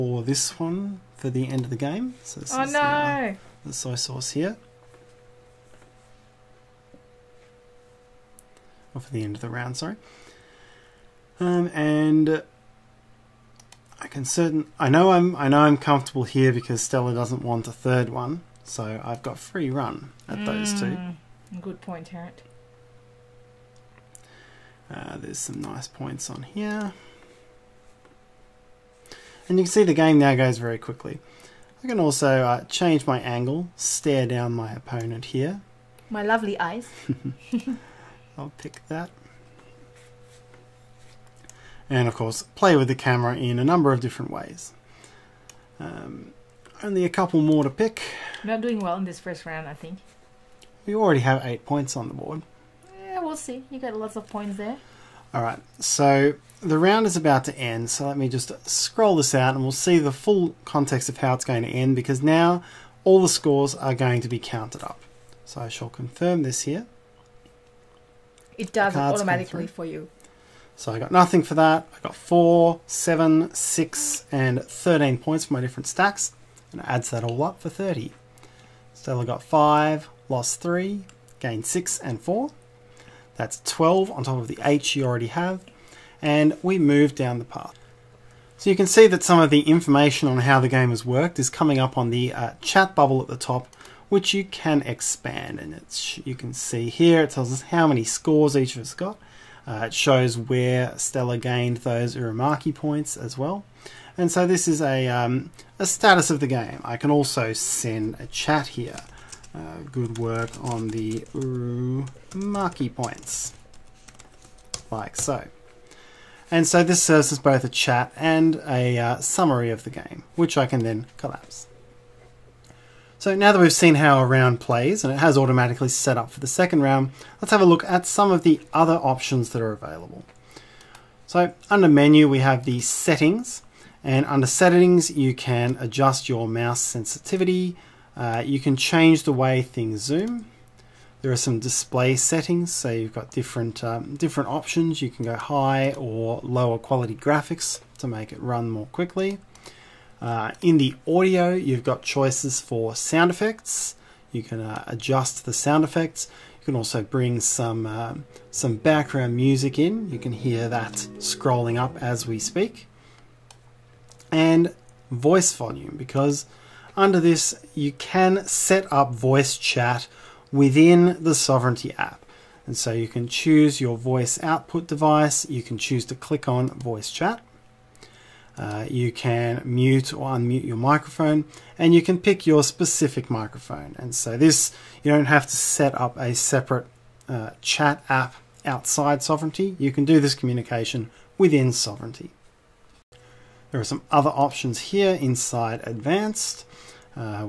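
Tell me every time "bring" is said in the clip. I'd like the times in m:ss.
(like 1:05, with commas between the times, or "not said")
2:37.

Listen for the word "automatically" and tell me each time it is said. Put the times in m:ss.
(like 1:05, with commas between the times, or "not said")
1:08, 2:05.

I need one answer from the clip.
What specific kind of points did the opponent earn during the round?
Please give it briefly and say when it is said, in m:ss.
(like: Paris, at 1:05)
Uramaki points, at 1:42.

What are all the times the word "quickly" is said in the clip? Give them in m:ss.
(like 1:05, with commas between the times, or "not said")
0:30, 2:28.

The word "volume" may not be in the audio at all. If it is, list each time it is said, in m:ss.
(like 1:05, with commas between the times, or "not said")
2:45.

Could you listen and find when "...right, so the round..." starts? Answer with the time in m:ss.
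0:55.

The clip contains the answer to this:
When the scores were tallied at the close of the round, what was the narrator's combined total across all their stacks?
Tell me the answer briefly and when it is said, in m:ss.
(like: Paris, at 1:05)
30, at 1:17.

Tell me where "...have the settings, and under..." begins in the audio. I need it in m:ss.
2:12.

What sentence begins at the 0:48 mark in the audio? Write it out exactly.
Not doing well in this first round, I think.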